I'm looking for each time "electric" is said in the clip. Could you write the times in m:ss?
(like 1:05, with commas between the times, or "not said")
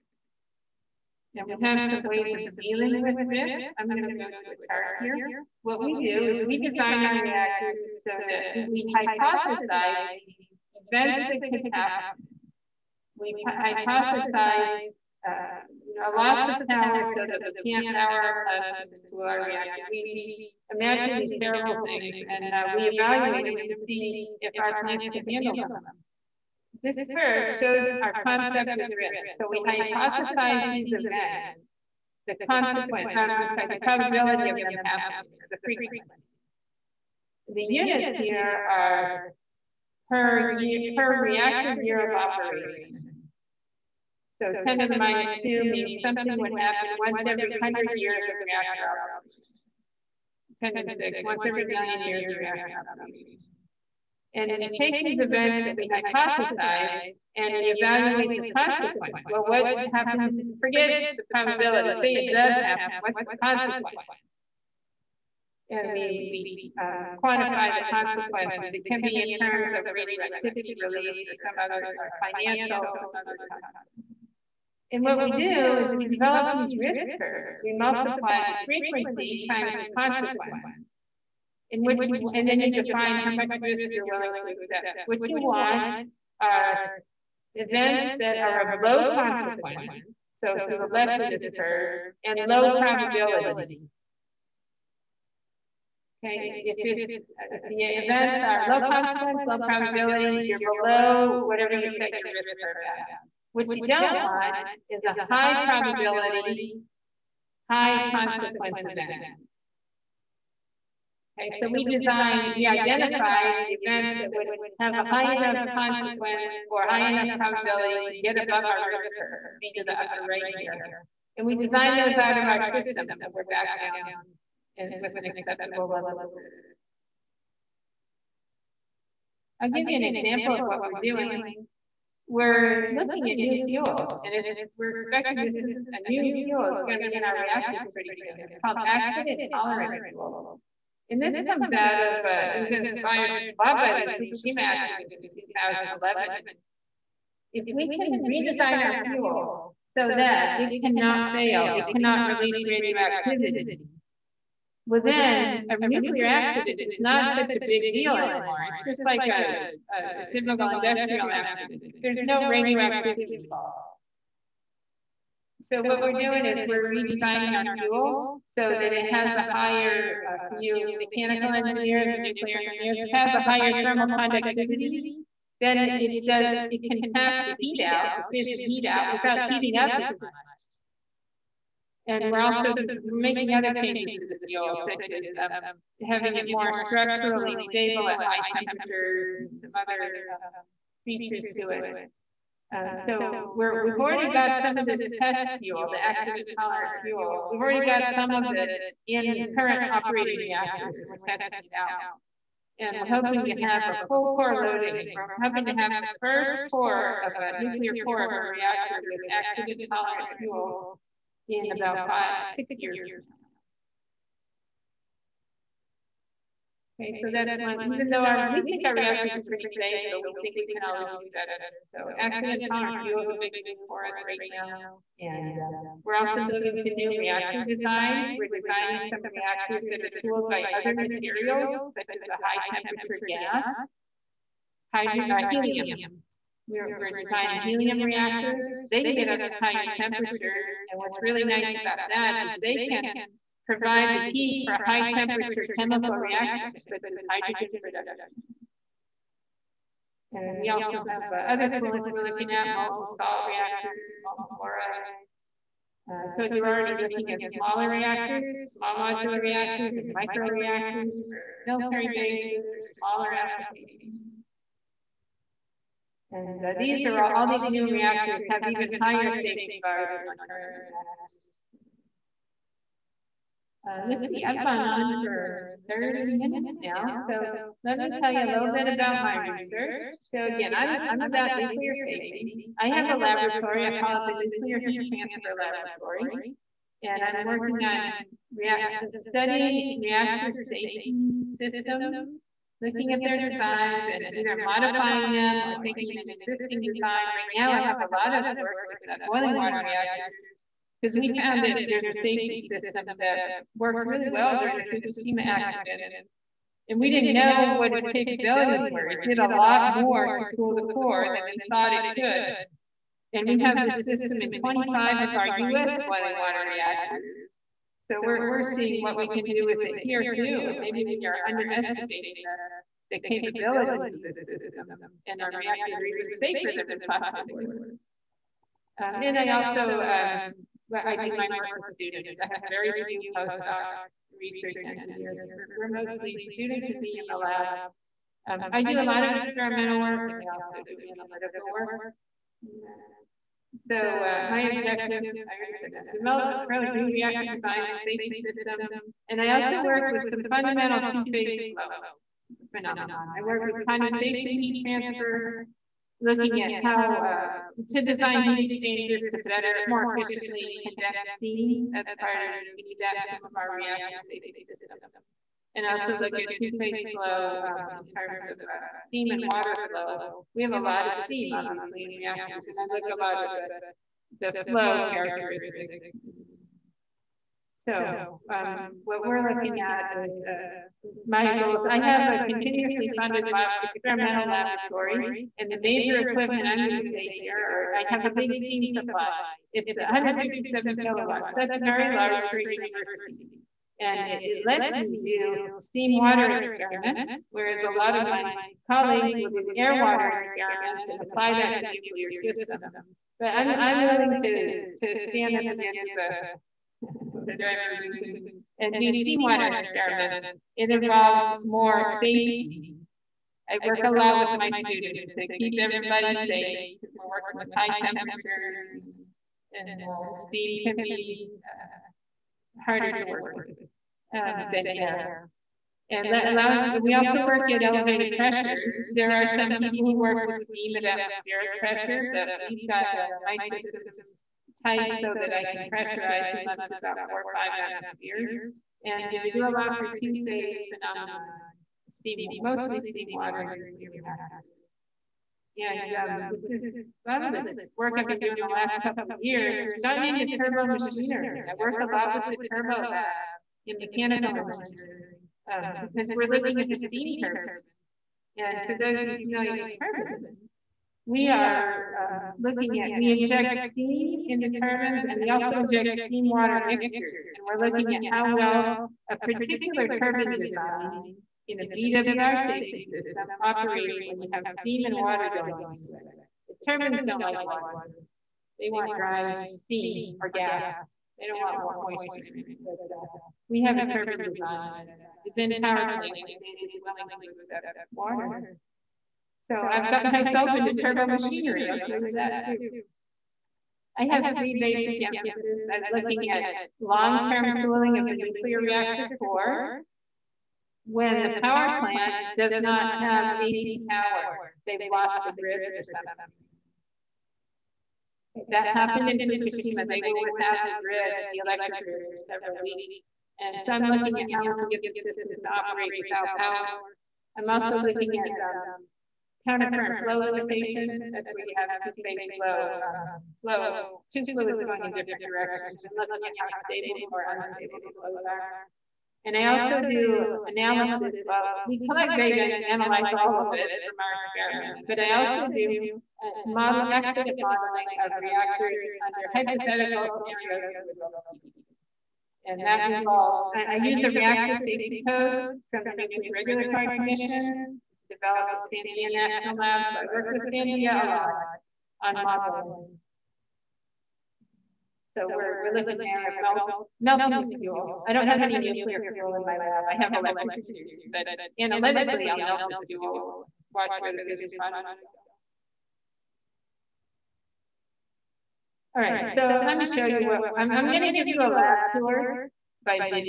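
8:31, 9:20.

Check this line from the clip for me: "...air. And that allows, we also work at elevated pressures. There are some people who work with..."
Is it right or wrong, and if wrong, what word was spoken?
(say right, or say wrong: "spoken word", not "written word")
right.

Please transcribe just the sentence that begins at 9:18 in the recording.
I don't have any nuclear fuel in my lab.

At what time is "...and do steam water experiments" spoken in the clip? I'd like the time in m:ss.
6:48.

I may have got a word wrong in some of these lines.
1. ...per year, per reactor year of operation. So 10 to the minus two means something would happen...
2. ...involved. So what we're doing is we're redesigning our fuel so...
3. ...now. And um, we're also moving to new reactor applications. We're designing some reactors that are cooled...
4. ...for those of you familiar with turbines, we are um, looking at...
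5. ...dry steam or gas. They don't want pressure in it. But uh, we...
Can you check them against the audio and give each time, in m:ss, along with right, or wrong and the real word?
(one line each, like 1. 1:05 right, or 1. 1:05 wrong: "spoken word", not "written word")
1. 0:40 right
2. 2:43 right
3. 3:44 wrong: "designs", not "applications"
4. 7:38 right
5. 7:59 wrong: "moisture", not "pressure".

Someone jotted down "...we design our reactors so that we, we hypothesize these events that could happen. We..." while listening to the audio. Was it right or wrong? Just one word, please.
right.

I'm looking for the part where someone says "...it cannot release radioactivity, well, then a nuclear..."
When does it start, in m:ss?
2:31.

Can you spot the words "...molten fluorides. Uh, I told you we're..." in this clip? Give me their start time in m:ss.
4:14.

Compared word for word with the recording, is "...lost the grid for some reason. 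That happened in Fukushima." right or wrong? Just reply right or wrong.
right.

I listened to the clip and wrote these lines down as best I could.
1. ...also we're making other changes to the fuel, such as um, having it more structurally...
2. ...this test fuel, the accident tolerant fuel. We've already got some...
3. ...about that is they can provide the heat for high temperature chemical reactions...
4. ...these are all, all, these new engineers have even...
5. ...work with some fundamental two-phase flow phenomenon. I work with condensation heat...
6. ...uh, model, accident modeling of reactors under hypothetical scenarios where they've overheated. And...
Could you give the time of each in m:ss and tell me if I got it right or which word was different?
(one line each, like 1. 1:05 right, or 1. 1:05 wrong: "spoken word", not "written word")
1. 3:02 right
2. 3:14 right
3. 4:01 right
4. 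4:26 wrong: "reactors", not "engineers"
5. 5:49 right
6. 8:56 right.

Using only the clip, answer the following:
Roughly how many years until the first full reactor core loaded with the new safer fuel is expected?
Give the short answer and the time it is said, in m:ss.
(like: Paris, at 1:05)
5 to 6 years, at 3:32.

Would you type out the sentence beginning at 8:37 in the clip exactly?
I'm also looking at um, countercurrent flow limitation.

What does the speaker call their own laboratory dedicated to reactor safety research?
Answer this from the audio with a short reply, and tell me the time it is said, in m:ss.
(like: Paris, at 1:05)
Nuclear Heat Transfer Laboratory, at 4:44.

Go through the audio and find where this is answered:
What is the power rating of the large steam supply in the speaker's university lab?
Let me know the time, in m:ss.
6:29.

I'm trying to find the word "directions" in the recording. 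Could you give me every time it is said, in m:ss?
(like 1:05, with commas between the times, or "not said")
8:45.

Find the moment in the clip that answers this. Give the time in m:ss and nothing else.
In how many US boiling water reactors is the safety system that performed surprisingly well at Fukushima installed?
5:14.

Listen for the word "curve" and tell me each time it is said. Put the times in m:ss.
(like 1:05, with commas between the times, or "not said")
0:27, 1:17, 1:31, 1:42, 1:59.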